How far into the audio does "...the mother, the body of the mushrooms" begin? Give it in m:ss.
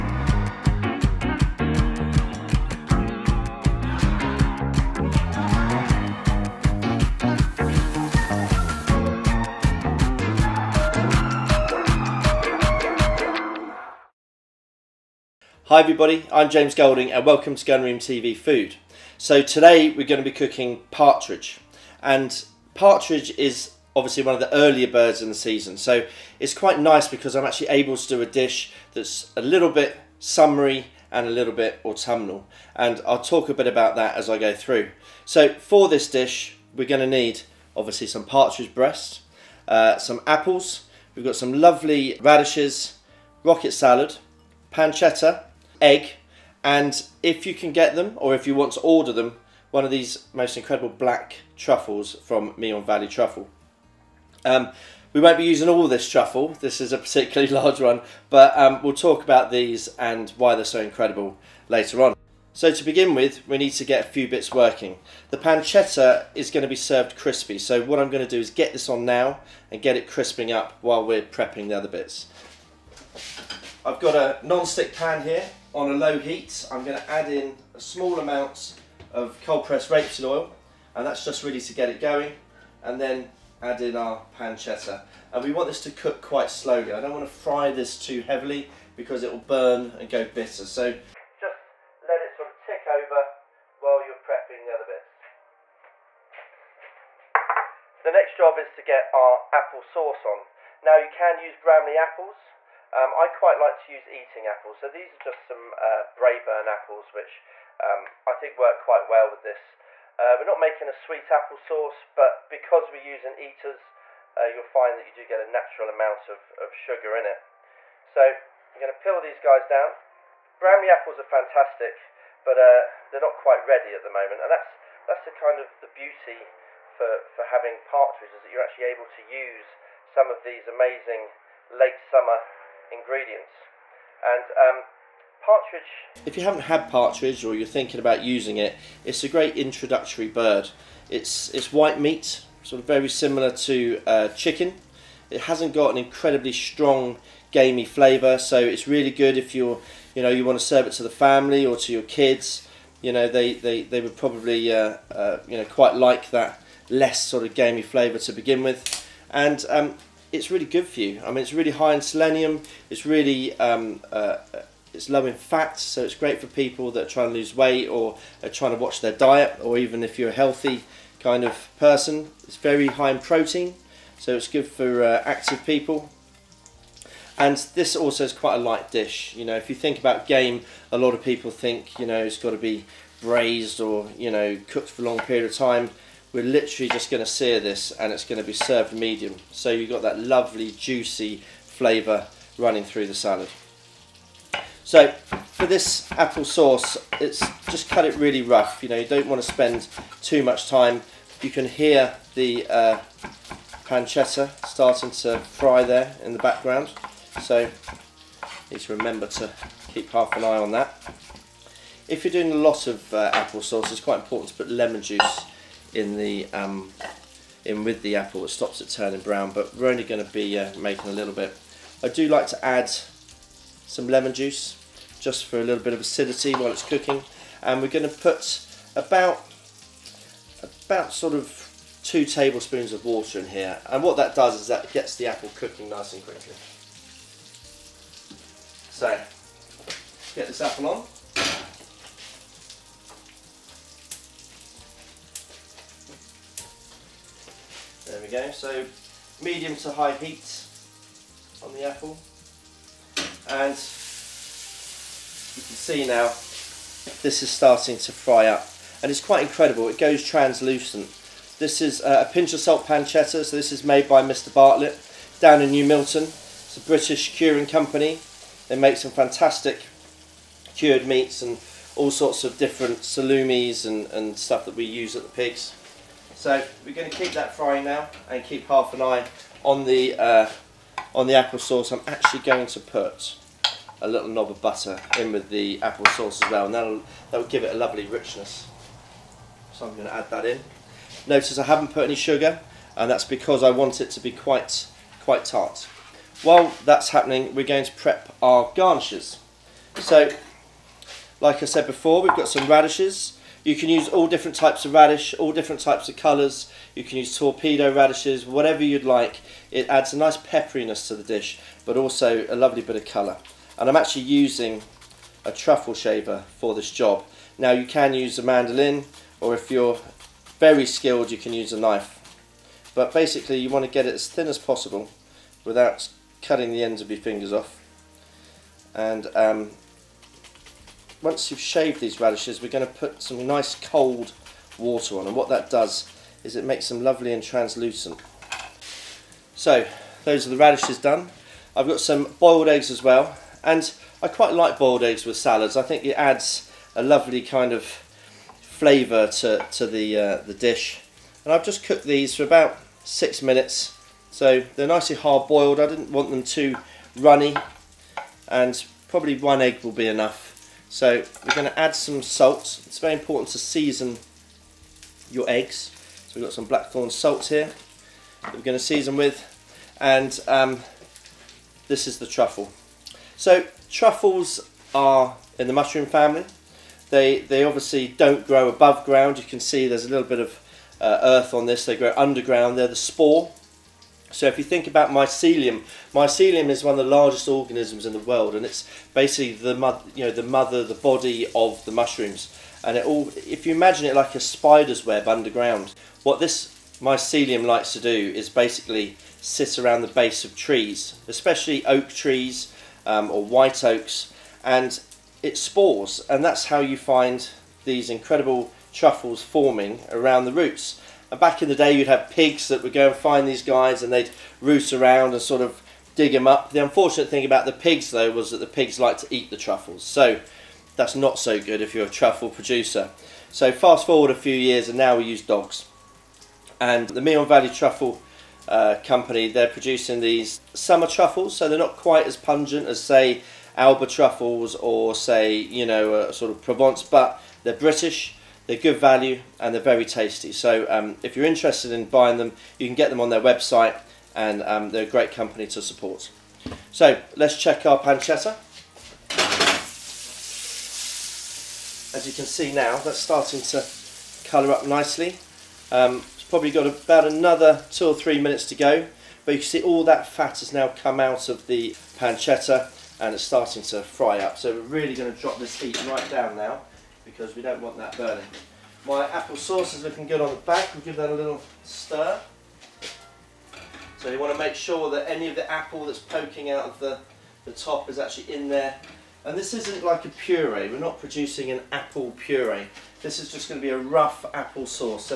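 6:30.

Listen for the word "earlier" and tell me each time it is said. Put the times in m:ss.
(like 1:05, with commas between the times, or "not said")
0:24.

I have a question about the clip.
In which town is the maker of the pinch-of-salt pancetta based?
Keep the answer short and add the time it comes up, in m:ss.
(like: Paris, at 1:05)
New Milton, at 4:25.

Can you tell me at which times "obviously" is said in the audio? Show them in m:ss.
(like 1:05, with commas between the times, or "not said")
0:23, 0:37, 6:17.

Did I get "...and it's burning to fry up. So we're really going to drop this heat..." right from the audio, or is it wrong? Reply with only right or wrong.
wrong.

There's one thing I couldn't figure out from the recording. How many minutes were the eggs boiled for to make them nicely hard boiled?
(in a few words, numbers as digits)
6.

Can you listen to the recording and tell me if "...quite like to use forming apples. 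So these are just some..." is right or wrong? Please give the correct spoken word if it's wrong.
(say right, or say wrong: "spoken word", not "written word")
wrong: "eating", not "forming".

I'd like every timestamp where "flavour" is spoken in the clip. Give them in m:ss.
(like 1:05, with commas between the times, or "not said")
2:27, 2:37, 3:11, 5:47.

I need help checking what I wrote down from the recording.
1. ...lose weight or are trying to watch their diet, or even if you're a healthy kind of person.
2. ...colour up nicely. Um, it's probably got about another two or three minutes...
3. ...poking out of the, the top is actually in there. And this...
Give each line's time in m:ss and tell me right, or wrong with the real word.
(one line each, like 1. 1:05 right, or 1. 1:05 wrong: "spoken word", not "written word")
1. 2:47 right
2. 7:34 right
3. 7:56 right.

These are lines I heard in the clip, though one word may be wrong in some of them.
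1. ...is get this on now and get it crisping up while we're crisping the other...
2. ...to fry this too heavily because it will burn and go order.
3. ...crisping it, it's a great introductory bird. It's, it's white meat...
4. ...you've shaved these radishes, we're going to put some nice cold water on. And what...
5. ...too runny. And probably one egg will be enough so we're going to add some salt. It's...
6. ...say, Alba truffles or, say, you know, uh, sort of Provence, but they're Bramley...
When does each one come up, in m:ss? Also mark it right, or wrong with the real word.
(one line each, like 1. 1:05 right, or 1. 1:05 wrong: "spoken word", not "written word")
1. 1:08 wrong: "prepping", not "crisping"
2. 1:27 wrong: "bitter", not "order"
3. 2:18 wrong: "using", not "crisping"
4. 5:31 right
5. 5:56 right
6. 7:13 wrong: "British", not "Bramley".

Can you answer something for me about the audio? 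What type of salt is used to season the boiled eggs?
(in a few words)
Blackthorn salt.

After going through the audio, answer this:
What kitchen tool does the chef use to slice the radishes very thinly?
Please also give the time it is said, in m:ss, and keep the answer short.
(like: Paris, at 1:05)
Truffle shaver, at 5:15.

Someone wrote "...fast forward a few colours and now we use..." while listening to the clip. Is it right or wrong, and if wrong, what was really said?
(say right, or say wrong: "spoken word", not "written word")
wrong: "years", not "colours".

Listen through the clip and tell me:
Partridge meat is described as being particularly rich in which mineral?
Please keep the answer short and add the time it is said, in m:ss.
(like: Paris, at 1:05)
Selenium, at 2:42.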